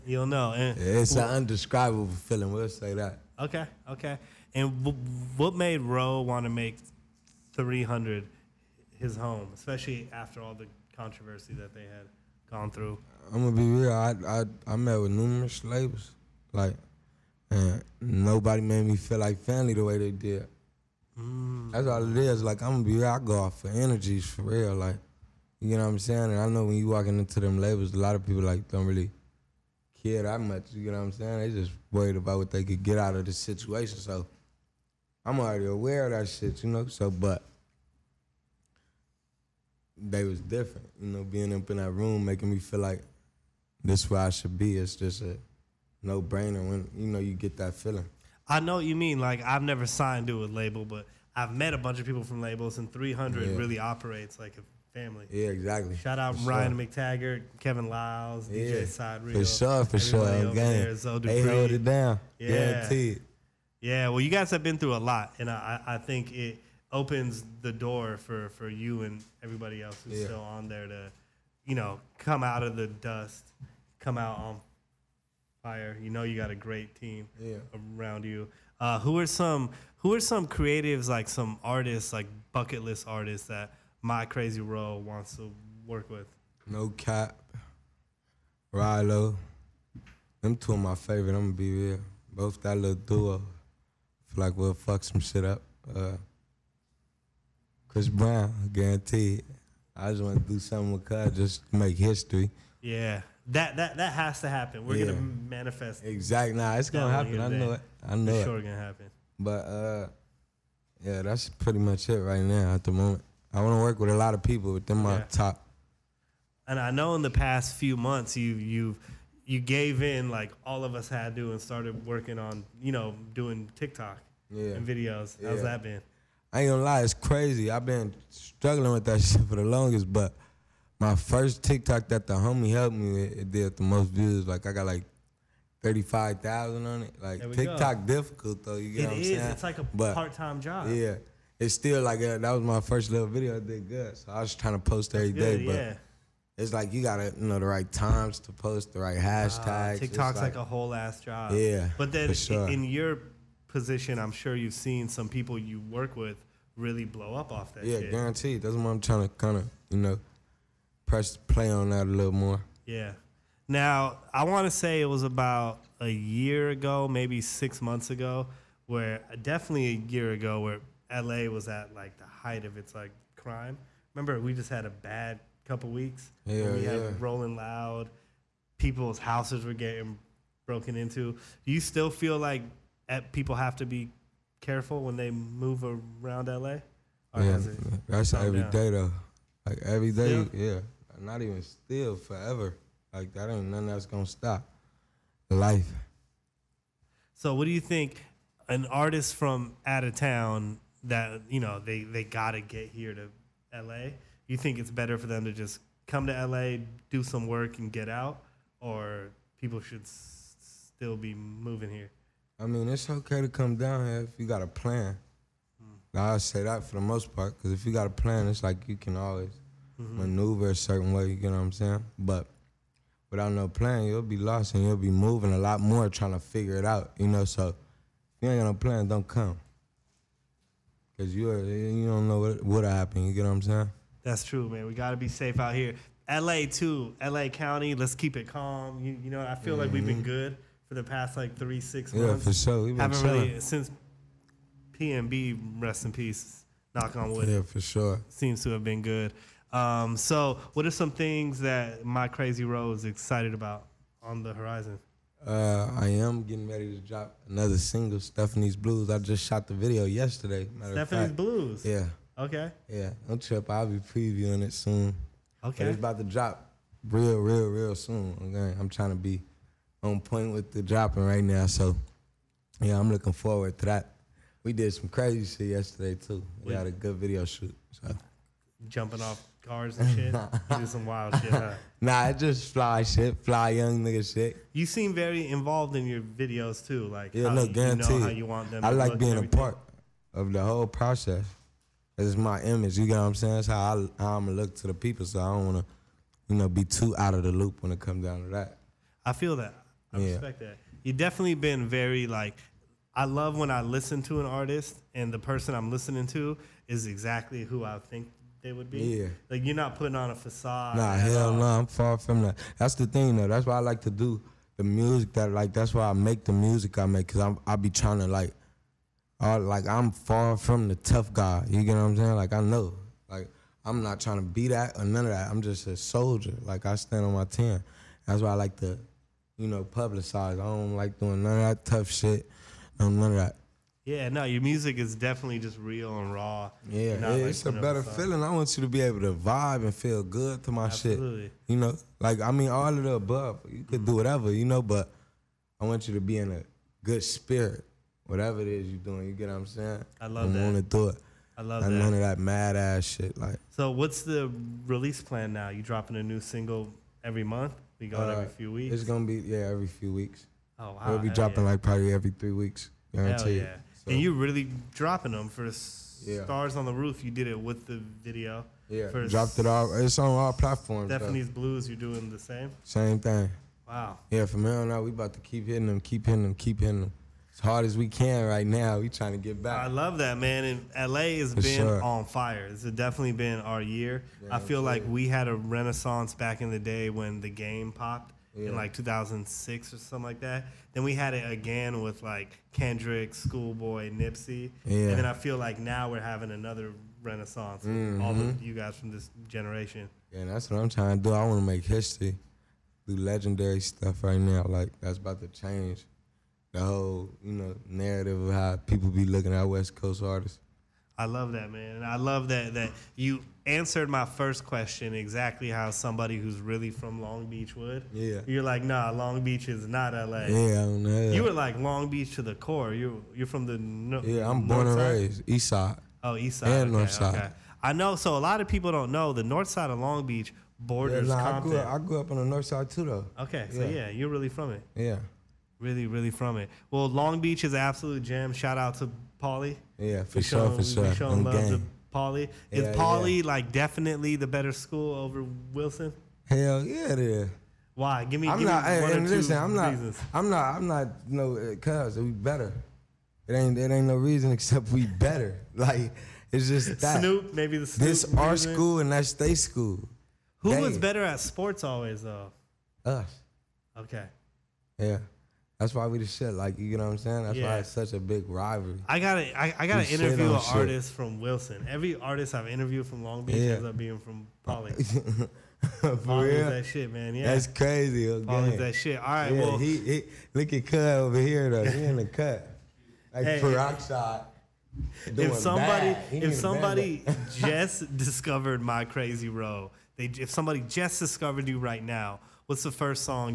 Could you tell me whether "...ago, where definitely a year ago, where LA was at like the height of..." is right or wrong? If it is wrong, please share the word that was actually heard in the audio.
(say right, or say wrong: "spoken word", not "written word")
right.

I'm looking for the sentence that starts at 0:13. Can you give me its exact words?
I I, I met with numerous labels, like, and nobody made me feel like family the way they did.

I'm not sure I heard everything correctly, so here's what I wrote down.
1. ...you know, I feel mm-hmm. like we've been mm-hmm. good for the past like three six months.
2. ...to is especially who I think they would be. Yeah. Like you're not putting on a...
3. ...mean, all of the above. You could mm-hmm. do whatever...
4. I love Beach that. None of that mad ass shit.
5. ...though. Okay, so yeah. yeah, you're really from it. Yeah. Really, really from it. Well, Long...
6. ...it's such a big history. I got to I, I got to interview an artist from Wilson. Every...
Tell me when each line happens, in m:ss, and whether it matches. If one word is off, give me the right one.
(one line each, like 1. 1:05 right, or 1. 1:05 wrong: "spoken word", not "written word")
1. 3:59 right
2. 5:06 wrong: "exactly", not "especially"
3. 5:42 right
4. 5:51 wrong: "Not", not "Beach"
5. 7:13 right
6. 7:47 wrong: "rivalry", not "history".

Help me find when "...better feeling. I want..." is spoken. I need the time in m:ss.
5:37.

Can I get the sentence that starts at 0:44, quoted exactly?
It's just a no brainer when you know you get that feeling.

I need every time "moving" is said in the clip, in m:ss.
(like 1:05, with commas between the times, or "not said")
3:31, 3:45.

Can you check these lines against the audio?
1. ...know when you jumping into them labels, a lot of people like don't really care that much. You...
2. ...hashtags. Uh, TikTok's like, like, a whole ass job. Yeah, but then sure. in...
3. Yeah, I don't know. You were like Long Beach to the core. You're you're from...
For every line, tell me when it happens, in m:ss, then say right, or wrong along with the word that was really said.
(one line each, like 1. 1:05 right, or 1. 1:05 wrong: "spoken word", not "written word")
1. 0:26 wrong: "walking", not "jumping"
2. 2:29 right
3. 7:00 right.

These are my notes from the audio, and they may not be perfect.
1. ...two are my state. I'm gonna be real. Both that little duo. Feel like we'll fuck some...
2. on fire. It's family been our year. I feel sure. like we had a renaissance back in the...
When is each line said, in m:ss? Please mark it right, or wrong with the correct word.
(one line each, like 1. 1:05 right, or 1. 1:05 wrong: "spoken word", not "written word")
1. 1:30 wrong: "favorite", not "state"
2. 6:22 wrong: "definitely", not "family".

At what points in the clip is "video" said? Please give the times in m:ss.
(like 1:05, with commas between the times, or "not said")
2:04, 2:23, 4:19, 4:37, 4:46, 6:08.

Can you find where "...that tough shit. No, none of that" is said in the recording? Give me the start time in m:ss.
5:31.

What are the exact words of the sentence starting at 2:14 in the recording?
Like I got like thirty-five thousand on it.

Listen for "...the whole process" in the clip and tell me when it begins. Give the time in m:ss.
4:50.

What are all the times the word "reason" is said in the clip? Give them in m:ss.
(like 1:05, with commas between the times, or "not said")
7:29, 7:34, 7:38.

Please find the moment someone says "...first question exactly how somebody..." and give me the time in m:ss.
6:54.